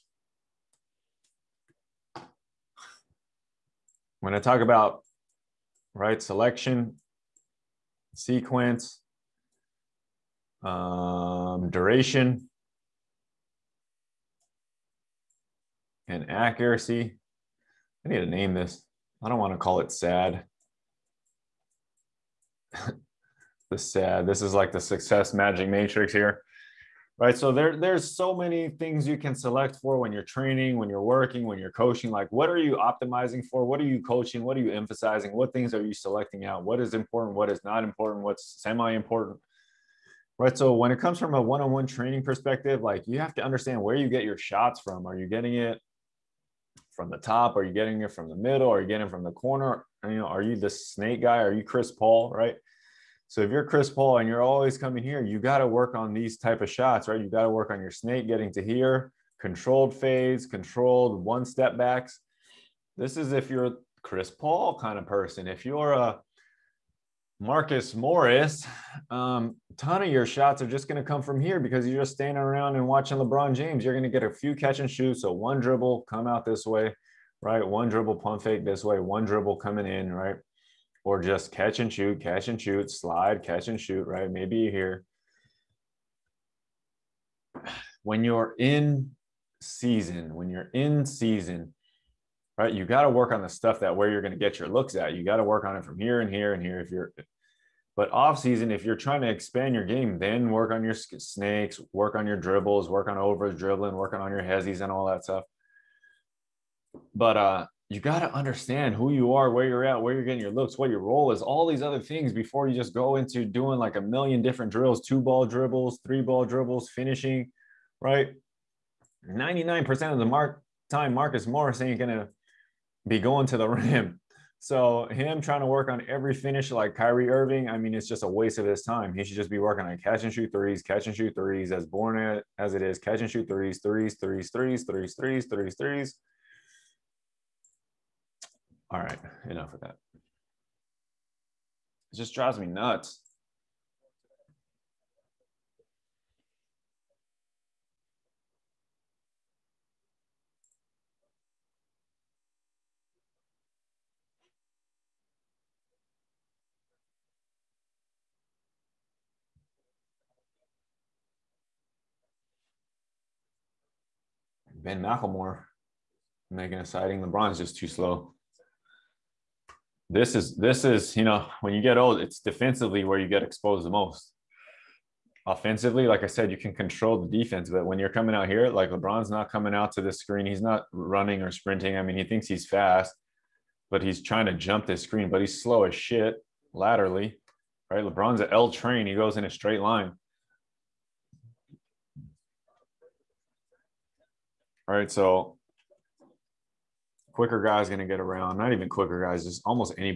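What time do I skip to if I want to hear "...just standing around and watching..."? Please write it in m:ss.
1:12.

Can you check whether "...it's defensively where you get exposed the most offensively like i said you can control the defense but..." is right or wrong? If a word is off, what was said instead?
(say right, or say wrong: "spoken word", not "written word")
right.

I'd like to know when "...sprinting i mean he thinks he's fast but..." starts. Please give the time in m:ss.
3:01.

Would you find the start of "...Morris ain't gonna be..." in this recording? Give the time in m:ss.
2:01.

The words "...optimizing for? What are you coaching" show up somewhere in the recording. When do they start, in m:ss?
0:32.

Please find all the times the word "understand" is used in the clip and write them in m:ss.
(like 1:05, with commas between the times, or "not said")
0:43, 1:48.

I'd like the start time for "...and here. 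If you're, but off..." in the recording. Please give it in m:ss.
1:36.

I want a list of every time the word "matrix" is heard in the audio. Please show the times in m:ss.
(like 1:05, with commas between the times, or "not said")
0:25.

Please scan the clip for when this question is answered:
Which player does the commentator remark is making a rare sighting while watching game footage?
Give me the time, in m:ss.
2:44.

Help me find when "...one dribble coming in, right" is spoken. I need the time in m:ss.
1:19.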